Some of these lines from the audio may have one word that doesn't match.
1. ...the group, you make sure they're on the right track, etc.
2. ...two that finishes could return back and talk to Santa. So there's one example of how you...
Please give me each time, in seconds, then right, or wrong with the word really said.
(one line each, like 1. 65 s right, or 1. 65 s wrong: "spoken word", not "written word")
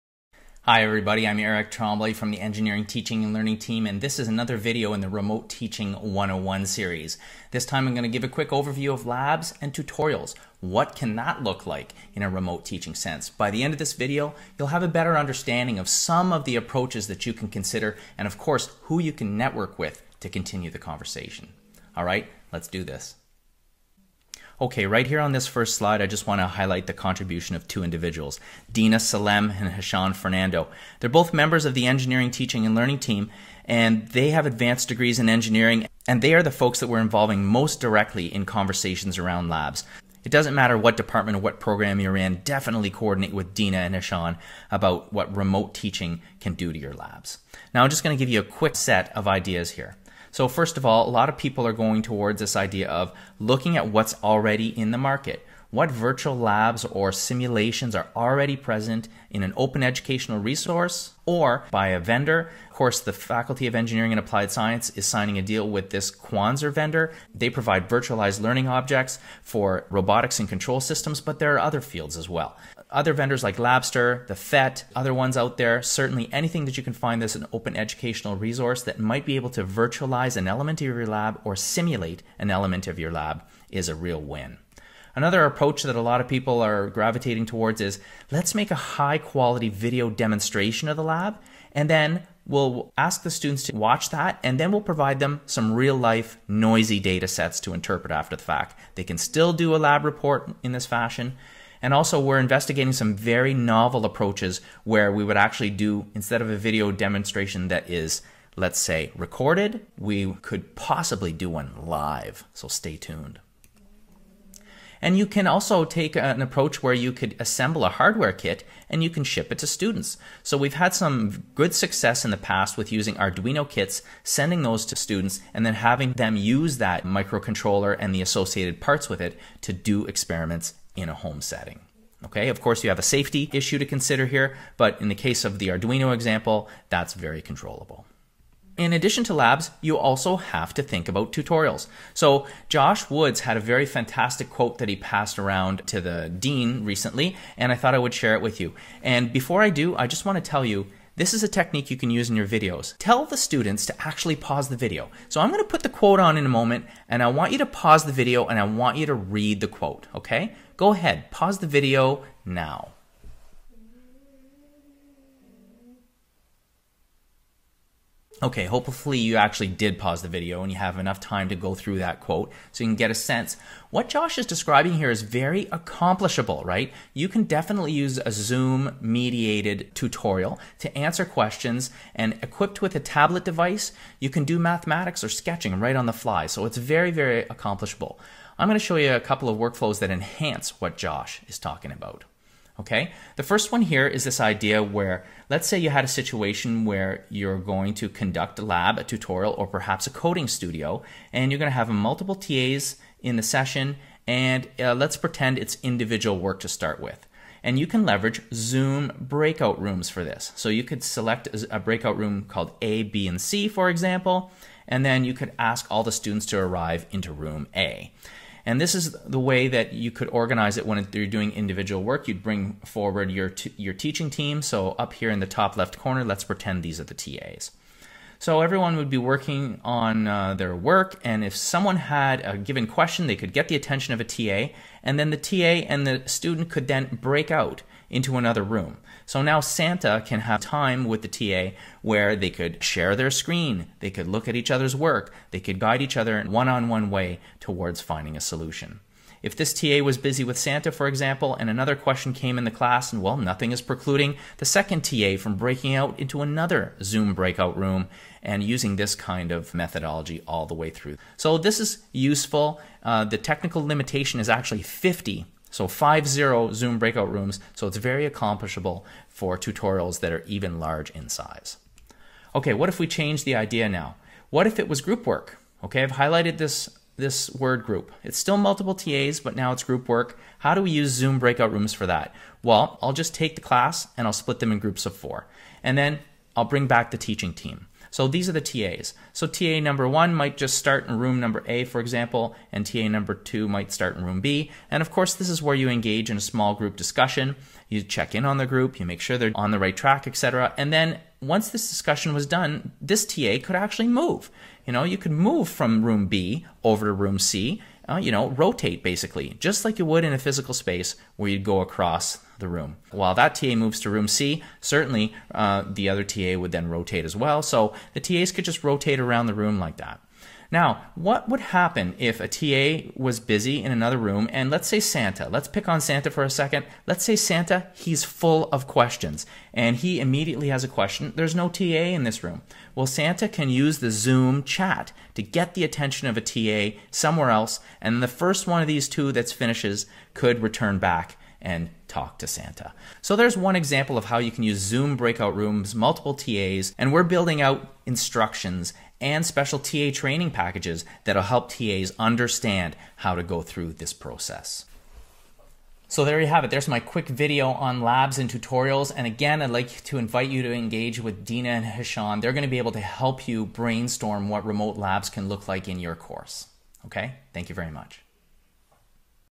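1. 298 s right
2. 339 s right.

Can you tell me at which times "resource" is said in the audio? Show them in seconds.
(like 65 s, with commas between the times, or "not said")
60 s, 78 s.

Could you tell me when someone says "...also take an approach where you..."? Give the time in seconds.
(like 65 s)
115 s.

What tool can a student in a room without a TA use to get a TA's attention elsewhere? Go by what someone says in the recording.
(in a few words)
Zoom chat.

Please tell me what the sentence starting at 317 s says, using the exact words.
So the TAs could just rotate around the room like that.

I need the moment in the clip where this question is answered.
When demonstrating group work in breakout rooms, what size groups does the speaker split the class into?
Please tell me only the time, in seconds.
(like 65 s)
285 s.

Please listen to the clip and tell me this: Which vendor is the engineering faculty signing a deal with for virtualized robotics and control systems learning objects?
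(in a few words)
Quanser.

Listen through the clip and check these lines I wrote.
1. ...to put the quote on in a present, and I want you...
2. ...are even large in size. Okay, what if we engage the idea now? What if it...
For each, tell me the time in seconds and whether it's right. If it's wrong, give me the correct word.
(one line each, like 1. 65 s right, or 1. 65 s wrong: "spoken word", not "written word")
1. 155 s wrong: "moment", not "present"
2. 270 s wrong: "change", not "engage".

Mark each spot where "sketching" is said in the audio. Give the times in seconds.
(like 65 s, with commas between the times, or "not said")
185 s.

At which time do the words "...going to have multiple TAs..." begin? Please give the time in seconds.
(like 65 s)
201 s.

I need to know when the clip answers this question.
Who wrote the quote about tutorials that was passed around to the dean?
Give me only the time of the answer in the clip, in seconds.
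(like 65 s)
142 s.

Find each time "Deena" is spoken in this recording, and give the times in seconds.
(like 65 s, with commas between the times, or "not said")
28 s, 43 s, 361 s.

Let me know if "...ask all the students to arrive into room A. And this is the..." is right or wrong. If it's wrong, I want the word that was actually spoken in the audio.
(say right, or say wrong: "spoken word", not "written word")
right.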